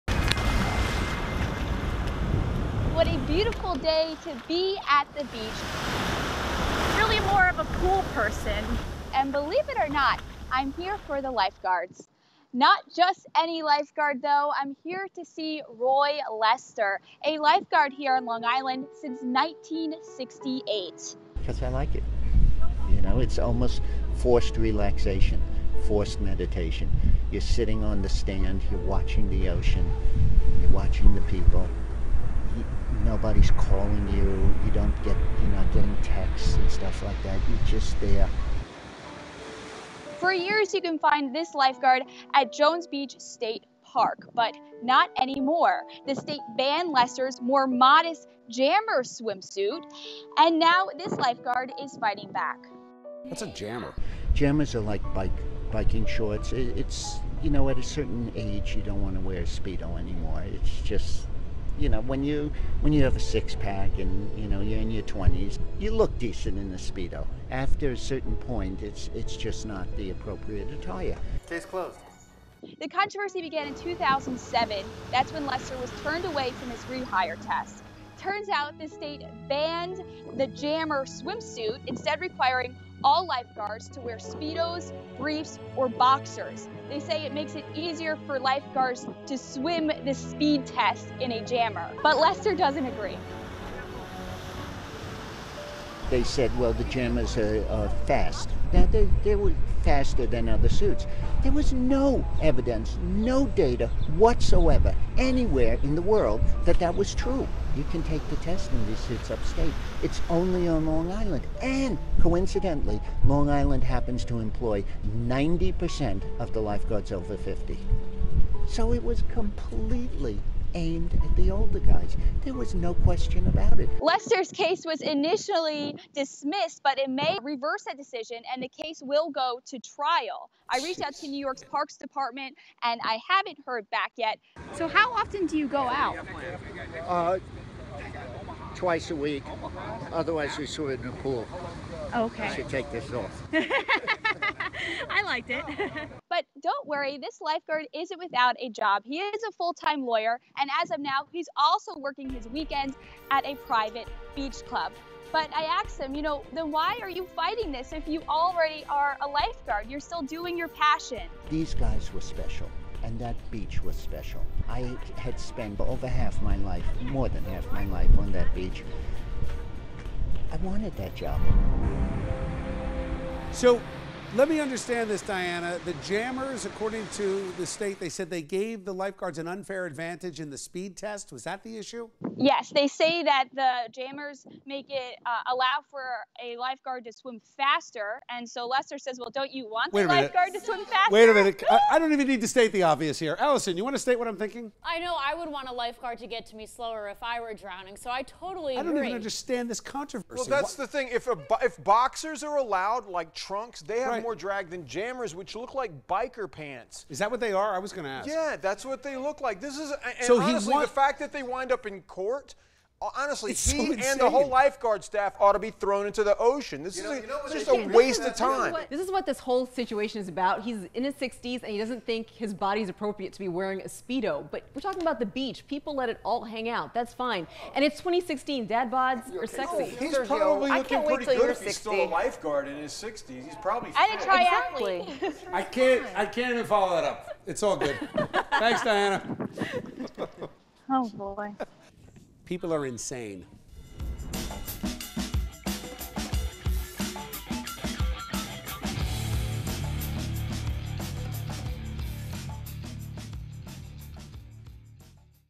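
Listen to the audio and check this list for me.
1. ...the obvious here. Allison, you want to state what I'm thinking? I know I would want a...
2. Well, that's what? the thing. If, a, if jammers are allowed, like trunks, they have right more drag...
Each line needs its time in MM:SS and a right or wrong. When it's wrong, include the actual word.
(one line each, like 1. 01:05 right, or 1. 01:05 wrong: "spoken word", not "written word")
1. 03:12 right
2. 03:20 wrong: "boxers", not "jammers".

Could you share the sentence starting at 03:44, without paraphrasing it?
But we're talking about the beach.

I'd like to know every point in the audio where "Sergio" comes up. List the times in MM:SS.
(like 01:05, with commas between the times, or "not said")
03:50.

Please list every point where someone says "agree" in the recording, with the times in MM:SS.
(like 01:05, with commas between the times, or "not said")
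01:32.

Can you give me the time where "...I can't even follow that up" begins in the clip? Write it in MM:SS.
03:56.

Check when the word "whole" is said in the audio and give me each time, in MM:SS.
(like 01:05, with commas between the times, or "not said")
03:34, 03:39.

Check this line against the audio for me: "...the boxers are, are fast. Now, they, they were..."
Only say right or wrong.
wrong.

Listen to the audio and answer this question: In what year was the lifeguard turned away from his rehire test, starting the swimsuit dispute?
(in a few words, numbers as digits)
2007.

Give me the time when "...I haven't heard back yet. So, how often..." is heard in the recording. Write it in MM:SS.
02:13.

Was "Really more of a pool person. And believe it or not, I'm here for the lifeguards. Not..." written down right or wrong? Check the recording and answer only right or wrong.
right.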